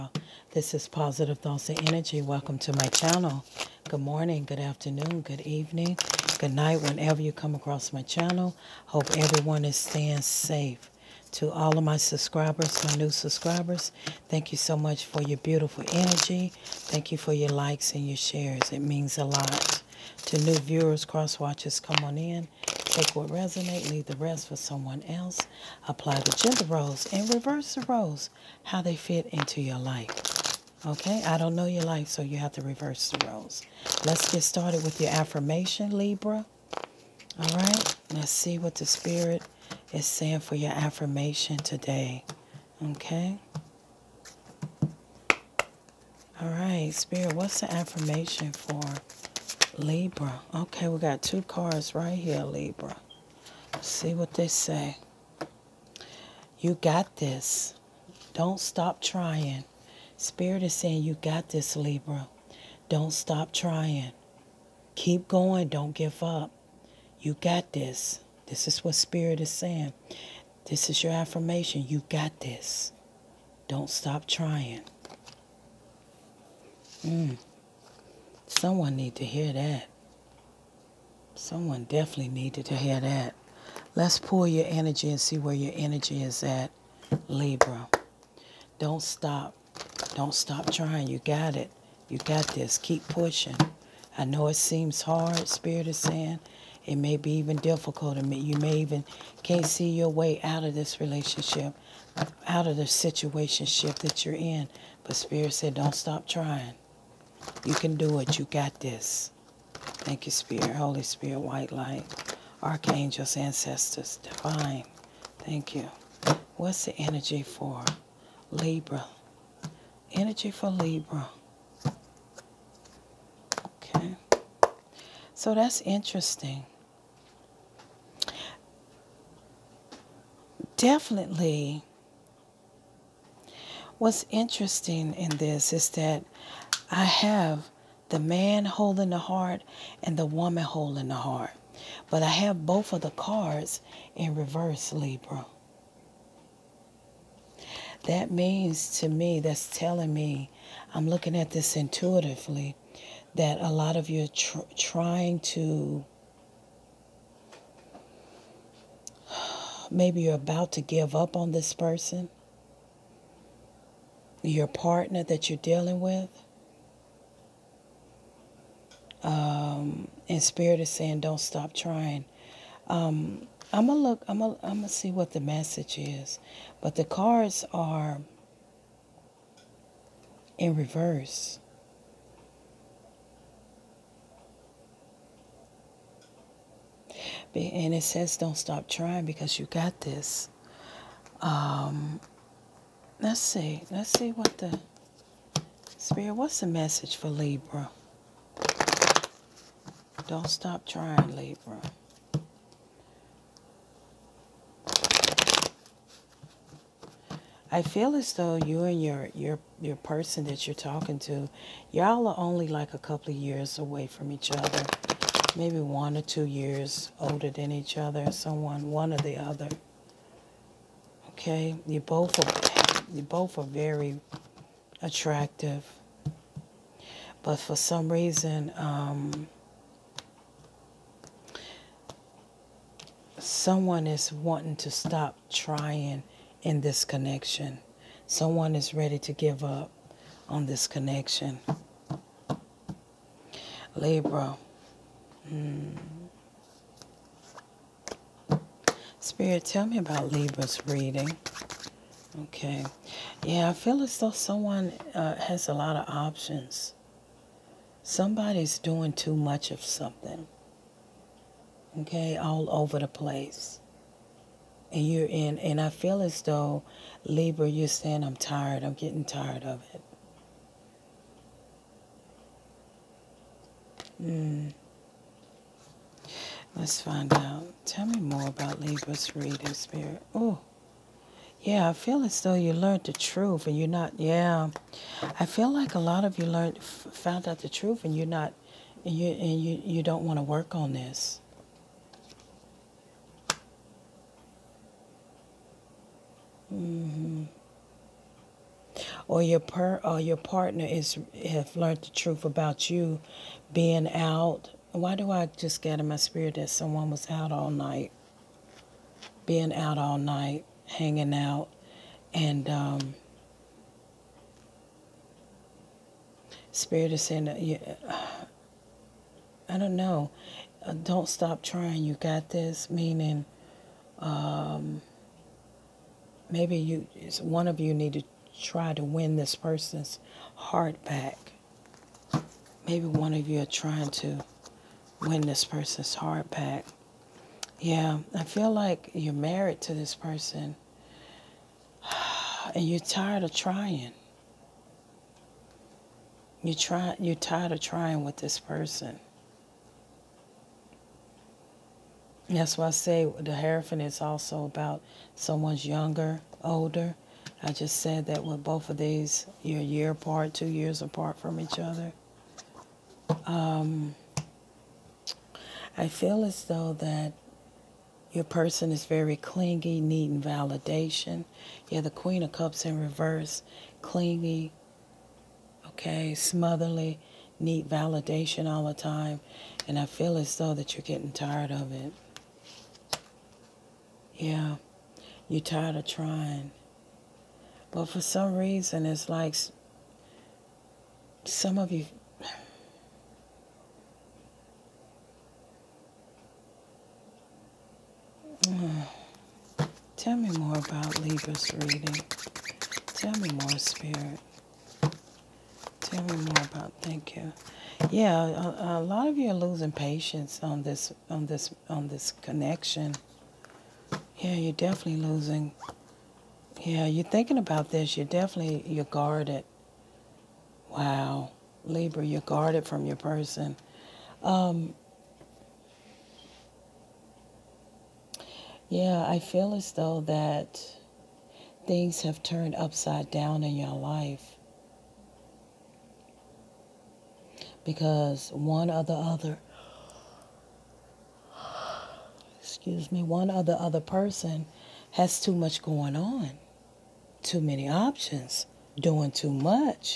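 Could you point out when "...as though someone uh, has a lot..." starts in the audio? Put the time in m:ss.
4:14.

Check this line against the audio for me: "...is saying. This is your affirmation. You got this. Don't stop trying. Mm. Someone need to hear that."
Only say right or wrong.
right.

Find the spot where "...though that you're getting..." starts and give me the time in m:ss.
6:20.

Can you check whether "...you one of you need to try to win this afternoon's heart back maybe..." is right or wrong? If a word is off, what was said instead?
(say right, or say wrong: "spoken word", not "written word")
wrong: "person", not "afternoon".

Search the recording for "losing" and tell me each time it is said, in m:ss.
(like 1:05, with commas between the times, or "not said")
6:49, 6:55.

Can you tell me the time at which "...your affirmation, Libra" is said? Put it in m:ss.
0:35.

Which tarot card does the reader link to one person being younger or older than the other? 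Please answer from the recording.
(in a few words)
The Hierophant.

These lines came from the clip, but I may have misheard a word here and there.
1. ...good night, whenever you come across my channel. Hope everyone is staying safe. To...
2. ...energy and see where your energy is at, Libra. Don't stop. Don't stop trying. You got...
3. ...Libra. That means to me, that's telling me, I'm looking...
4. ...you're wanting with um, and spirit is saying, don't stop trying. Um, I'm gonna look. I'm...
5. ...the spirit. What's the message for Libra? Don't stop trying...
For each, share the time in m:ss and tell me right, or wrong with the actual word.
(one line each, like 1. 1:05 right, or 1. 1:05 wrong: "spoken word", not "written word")
1. 0:06 right
2. 1:24 right
3. 2:24 right
4. 2:45 wrong: "dealing", not "wanting"
5. 3:14 right.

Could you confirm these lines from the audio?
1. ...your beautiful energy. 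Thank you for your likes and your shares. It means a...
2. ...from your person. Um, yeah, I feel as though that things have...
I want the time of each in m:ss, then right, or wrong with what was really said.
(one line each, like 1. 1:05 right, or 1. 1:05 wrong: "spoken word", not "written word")
1. 0:15 right
2. 7:02 right.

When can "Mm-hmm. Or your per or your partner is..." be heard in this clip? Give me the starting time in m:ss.
4:56.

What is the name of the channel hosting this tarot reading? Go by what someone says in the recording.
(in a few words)
Positive Thoughts and Energy.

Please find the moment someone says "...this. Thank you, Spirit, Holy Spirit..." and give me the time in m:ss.
1:48.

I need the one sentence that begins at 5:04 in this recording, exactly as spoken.
Why do I just get in my spirit that someone was out all night?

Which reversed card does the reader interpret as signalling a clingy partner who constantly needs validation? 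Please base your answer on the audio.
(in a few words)
Queen of Cups.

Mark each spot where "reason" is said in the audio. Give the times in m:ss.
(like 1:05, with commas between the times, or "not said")
3:48, 6:28.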